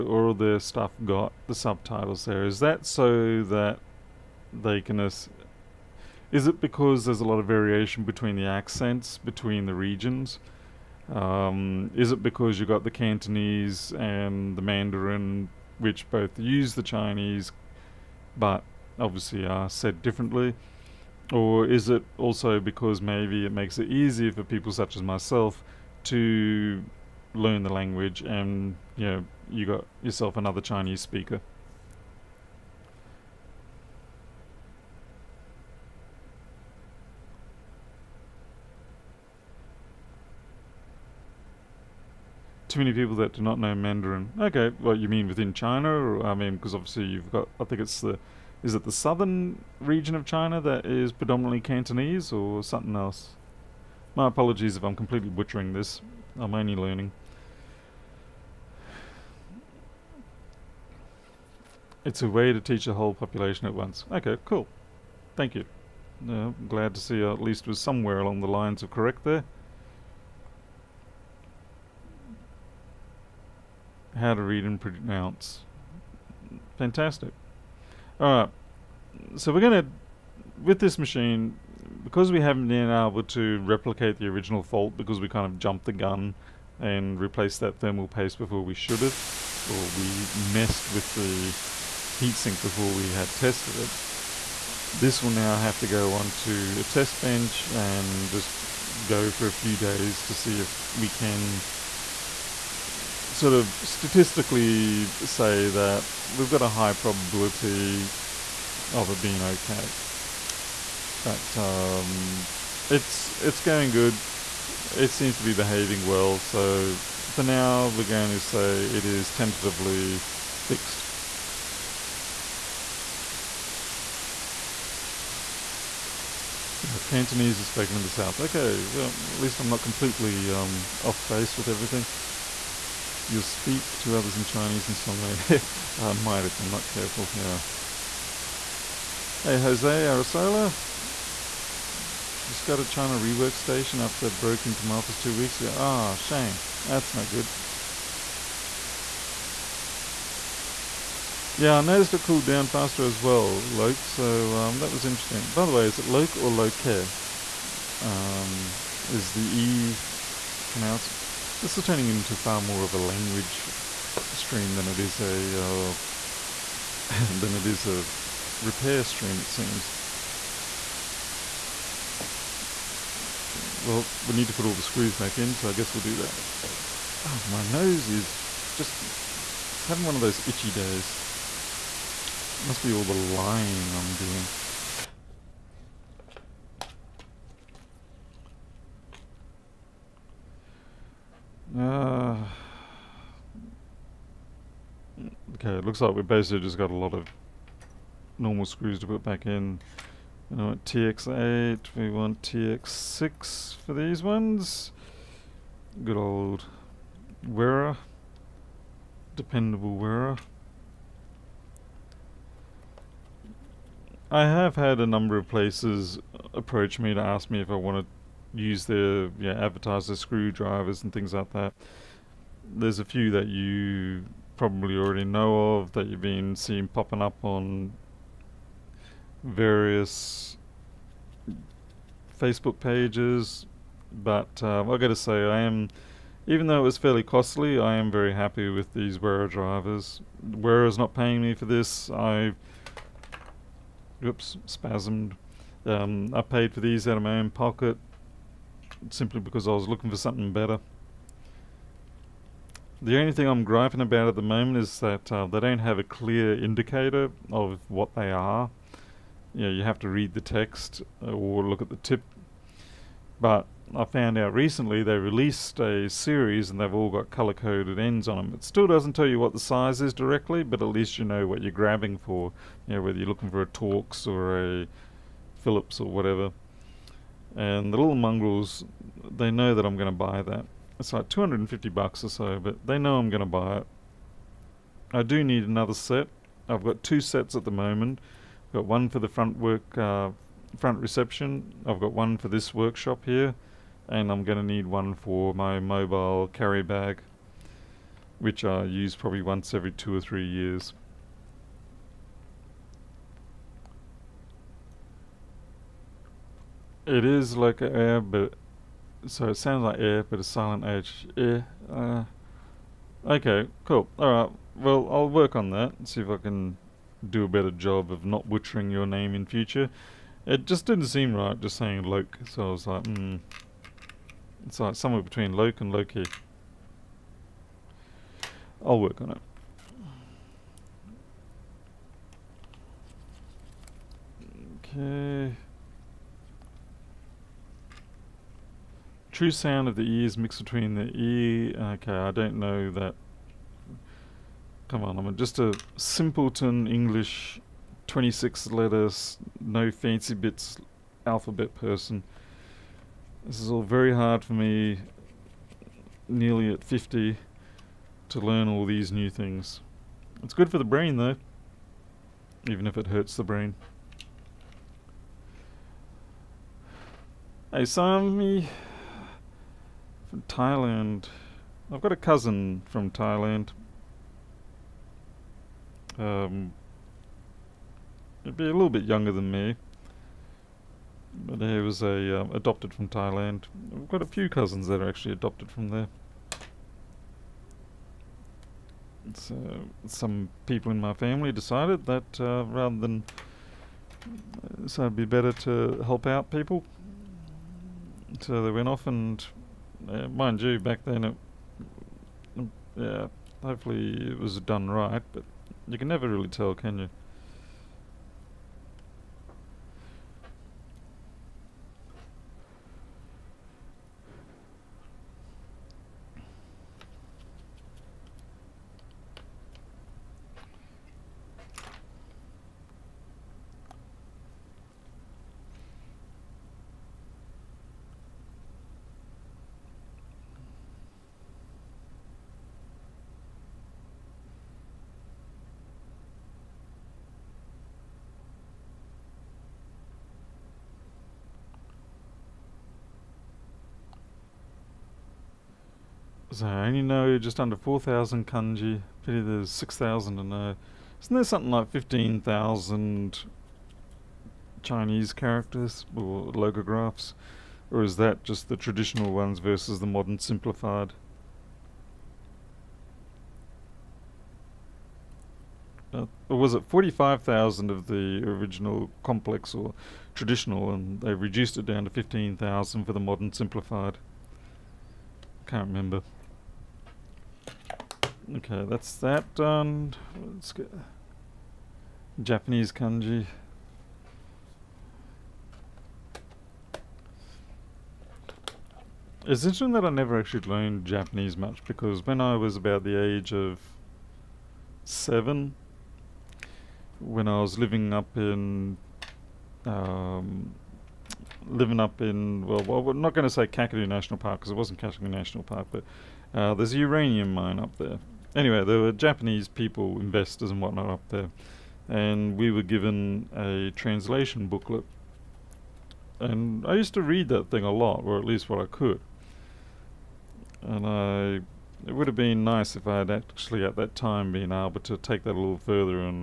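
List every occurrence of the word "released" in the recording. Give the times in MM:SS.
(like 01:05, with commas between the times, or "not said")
04:25.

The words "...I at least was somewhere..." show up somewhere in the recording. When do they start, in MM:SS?
01:07.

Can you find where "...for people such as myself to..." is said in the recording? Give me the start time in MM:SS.
00:24.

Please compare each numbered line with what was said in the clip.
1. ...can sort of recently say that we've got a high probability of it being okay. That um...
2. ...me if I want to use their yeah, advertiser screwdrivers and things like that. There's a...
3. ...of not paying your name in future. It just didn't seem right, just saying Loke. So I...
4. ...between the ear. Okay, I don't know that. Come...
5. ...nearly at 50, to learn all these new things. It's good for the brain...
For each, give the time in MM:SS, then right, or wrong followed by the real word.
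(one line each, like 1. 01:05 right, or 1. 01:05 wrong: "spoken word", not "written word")
1. 01:41 wrong: "statistically", not "recently"
2. 03:37 right
3. 05:18 wrong: "butchering", not "paying"
4. 05:40 right
5. 05:56 right.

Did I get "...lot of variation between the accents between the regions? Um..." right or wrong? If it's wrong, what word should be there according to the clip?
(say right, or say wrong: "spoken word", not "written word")
right.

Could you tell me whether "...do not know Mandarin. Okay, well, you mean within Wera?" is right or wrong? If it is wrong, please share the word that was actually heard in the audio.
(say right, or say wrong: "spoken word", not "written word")
wrong: "China", not "Wera".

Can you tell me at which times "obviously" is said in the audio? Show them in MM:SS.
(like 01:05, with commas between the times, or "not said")
00:18, 00:46.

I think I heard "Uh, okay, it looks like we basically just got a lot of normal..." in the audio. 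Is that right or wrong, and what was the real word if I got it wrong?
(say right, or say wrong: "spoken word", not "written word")
right.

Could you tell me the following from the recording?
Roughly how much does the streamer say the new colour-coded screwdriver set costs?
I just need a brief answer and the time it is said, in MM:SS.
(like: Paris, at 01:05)
$250, at 04:41.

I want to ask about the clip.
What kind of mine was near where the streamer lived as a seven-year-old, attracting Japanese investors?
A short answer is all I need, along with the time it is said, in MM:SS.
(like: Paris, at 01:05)
uranium mine, at 08:26.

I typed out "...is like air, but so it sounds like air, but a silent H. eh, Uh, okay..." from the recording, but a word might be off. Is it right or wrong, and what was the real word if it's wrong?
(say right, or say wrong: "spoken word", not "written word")
right.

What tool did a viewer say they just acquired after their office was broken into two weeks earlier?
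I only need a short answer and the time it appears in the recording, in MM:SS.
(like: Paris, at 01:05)
China rework station, at 02:22.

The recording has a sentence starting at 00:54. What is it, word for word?
My apologies if I'm completely butchering this.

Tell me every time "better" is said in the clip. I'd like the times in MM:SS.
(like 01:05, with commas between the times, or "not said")
04:10, 05:17, 06:35.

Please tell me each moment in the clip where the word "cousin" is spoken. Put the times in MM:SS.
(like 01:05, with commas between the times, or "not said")
06:12, 06:24.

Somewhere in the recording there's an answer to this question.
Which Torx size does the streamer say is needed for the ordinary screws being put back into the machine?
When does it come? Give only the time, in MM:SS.
03:22.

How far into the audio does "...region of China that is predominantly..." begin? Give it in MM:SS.
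00:49.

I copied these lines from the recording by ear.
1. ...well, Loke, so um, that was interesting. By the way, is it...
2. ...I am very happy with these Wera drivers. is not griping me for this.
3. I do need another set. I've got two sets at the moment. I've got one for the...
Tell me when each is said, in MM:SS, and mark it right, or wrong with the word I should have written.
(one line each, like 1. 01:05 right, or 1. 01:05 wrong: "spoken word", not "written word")
1. 02:33 right
2. 03:57 wrong: "paying", not "griping"
3. 04:45 right.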